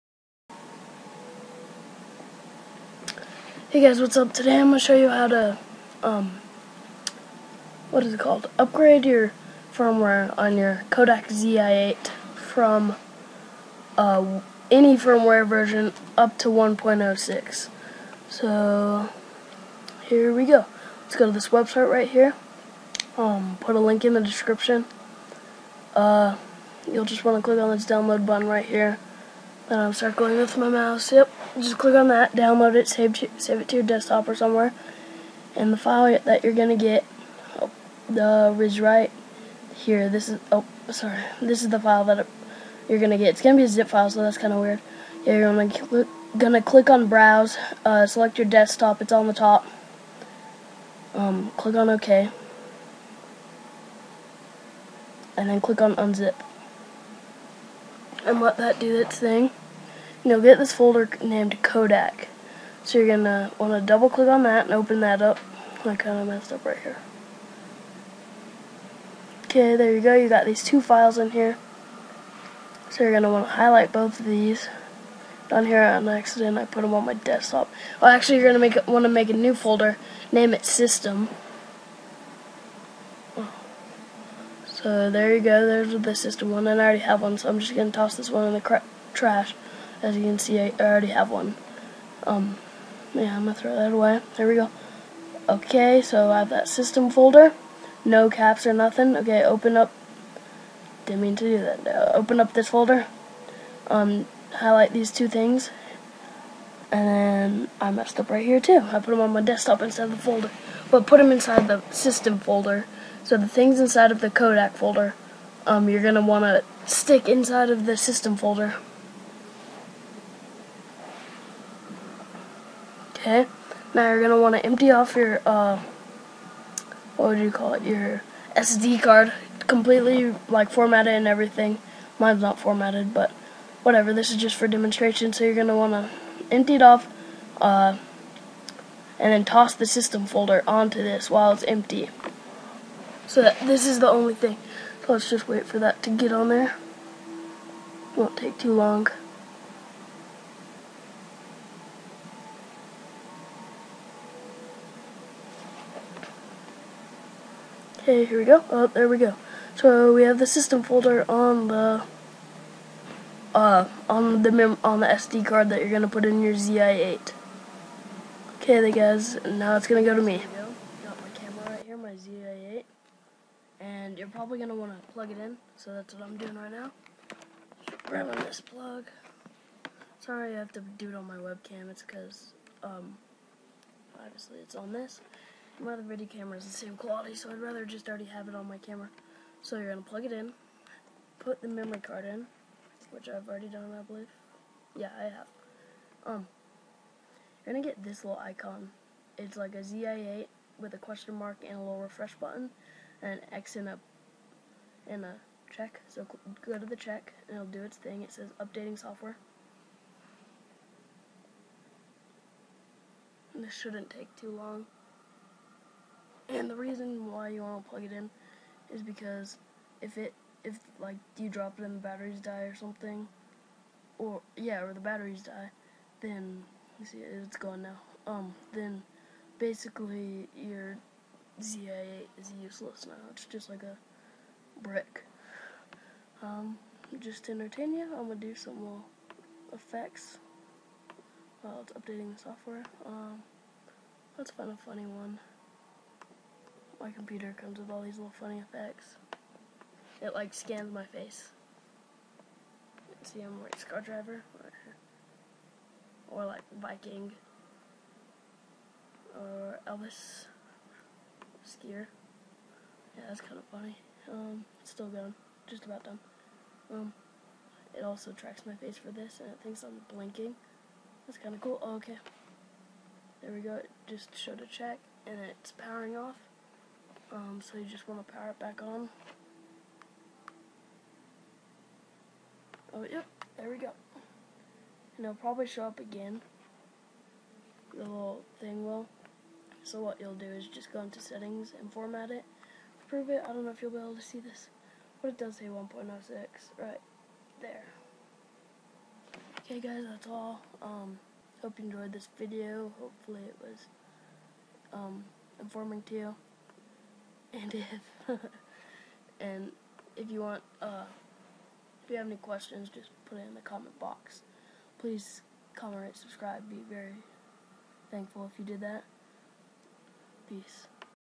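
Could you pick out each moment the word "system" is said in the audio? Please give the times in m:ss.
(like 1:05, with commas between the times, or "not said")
1:20, 1:26, 1:36, 1:51, 1:57, 2:19, 2:40.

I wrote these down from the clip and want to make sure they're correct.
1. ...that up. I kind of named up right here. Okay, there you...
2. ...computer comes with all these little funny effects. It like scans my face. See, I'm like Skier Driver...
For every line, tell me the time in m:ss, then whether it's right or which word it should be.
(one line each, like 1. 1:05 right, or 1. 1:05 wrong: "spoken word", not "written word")
1. 1:05 wrong: "messed", not "named"
2. 4:07 wrong: "Scar", not "Skier".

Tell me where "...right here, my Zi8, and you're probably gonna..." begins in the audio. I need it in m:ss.
2:51.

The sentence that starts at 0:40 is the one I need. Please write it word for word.
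This is oh sorry, this is the file that you're gonna get.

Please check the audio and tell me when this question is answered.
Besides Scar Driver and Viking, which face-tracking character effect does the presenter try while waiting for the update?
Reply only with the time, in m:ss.
4:19.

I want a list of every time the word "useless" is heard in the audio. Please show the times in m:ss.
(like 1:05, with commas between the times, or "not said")
3:52.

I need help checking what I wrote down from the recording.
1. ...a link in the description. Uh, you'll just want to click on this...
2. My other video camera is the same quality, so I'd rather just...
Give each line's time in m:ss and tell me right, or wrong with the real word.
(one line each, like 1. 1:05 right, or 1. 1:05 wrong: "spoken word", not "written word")
1. 0:23 right
2. 3:05 right.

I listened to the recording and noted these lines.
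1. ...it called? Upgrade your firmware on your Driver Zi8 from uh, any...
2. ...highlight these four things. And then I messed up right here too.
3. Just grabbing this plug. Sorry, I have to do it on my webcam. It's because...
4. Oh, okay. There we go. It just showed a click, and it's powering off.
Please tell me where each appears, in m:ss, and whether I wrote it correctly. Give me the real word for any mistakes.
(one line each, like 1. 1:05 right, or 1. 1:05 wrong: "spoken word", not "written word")
1. 0:08 wrong: "Kodak", not "Driver"
2. 1:44 wrong: "two", not "four"
3. 2:57 right
4. 4:31 wrong: "check", not "click".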